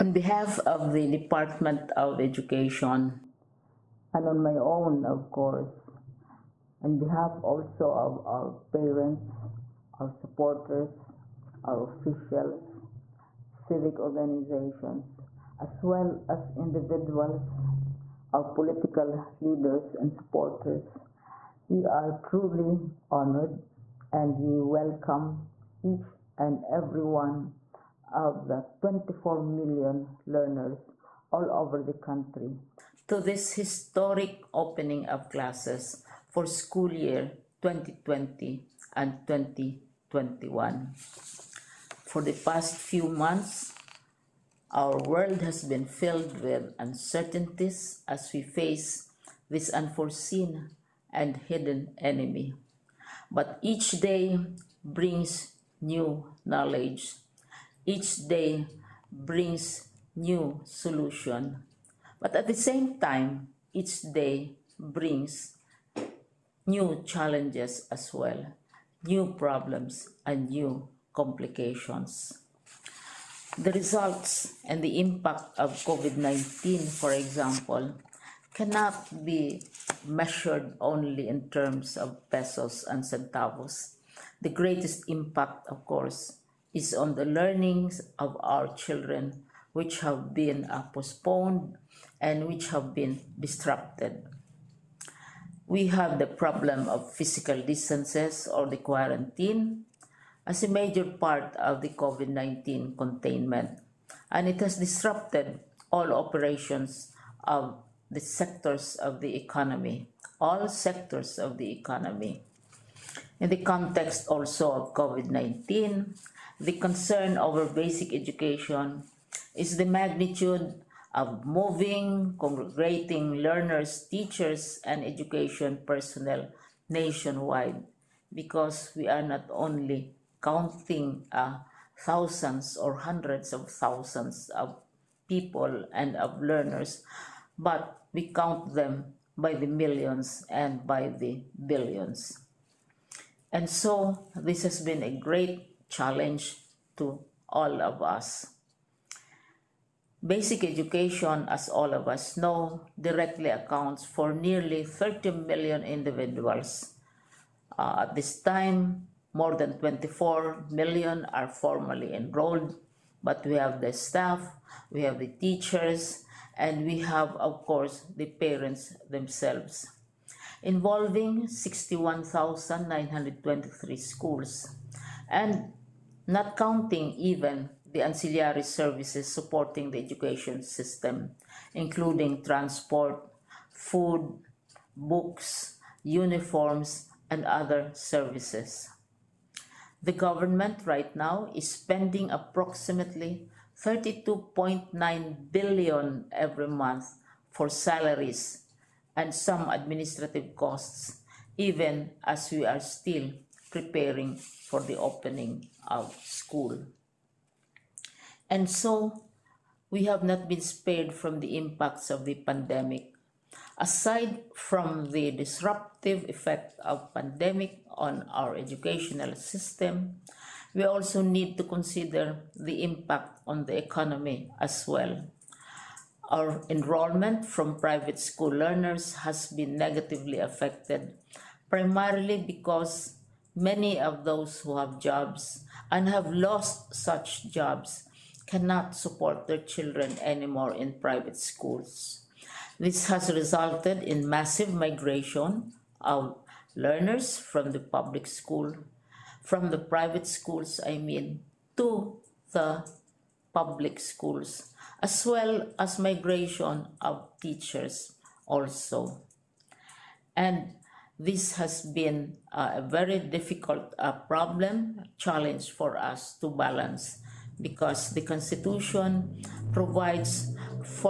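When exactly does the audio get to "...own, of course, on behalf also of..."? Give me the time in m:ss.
0:04.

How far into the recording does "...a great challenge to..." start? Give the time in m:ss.
2:25.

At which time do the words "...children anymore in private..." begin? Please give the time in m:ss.
3:59.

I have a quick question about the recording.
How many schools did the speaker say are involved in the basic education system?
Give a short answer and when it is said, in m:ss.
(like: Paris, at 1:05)
61,923, at 2:51.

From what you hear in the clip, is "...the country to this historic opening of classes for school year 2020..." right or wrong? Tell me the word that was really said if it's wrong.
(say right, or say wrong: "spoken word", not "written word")
right.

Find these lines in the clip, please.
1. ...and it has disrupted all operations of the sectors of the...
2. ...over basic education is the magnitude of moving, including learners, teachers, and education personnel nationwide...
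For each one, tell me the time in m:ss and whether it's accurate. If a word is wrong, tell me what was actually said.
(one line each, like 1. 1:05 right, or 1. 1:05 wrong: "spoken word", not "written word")
1. 1:44 right
2. 1:57 wrong: "congregating", not "including".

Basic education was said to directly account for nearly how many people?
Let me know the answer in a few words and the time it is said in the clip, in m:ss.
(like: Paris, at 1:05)
30 million, at 2:34.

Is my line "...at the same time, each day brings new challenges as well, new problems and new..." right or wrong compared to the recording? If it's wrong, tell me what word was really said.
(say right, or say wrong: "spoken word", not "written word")
right.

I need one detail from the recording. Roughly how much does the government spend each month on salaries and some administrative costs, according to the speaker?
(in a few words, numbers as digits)
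32.9 billion.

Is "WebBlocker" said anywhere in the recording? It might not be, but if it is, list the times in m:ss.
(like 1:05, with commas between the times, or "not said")
not said.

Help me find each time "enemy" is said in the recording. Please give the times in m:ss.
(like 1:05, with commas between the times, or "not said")
0:51.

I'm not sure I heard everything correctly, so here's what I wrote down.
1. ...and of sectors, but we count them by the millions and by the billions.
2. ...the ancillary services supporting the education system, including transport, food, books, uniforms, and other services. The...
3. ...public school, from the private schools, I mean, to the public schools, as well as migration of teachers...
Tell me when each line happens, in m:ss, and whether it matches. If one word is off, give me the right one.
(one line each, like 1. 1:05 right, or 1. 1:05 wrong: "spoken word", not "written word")
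1. 2:15 wrong: "learners", not "sectors"
2. 2:57 right
3. 4:07 right.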